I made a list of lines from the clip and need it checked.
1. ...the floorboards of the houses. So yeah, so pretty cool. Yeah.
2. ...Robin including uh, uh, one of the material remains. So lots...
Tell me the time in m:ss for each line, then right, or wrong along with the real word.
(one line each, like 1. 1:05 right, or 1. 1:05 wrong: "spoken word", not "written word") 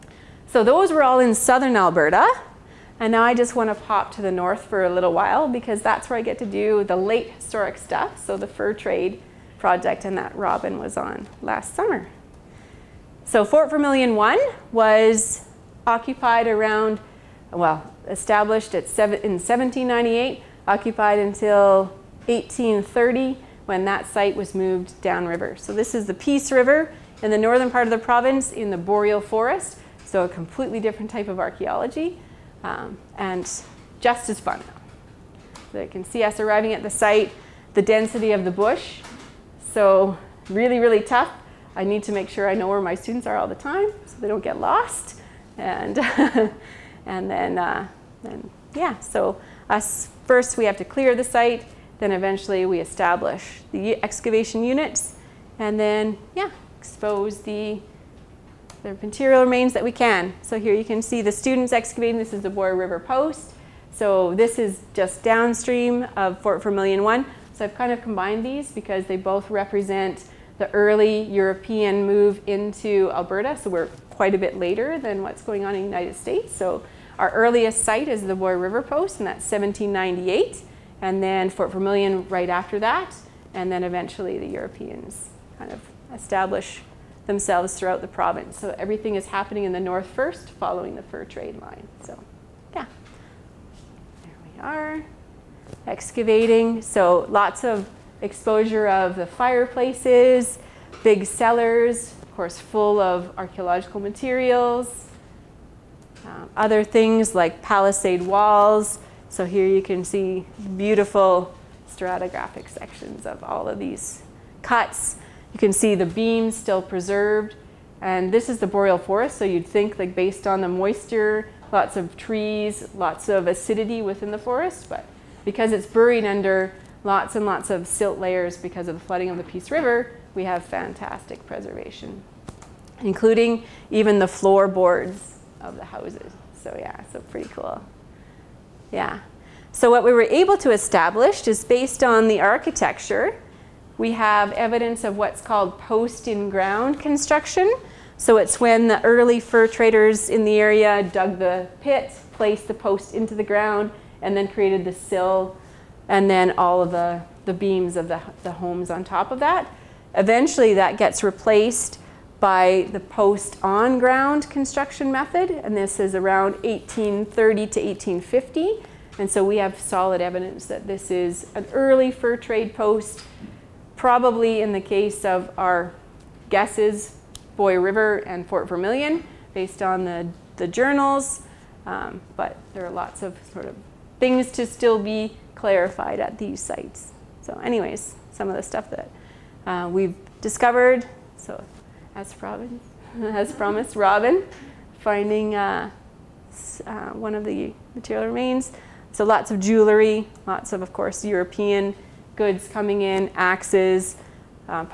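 1. 2:14 right
2. 3:13 wrong: "finding", not "including".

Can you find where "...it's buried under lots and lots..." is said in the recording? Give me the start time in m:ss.
2:05.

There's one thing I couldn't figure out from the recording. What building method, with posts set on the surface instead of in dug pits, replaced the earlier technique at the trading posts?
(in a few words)
post on ground construction.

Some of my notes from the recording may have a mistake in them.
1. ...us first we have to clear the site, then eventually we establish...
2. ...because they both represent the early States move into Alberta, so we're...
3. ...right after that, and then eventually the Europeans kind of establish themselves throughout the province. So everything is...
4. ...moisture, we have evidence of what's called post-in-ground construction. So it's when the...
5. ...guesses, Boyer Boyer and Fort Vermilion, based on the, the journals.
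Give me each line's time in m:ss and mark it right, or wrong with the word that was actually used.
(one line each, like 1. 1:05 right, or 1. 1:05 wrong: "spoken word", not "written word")
1. 0:49 right
2. 1:08 wrong: "European", not "States"
3. 1:22 right
4. 2:22 wrong: "architecture", not "moisture"
5. 2:56 wrong: "River", not "Boyer".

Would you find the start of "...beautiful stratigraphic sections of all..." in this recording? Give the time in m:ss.
1:50.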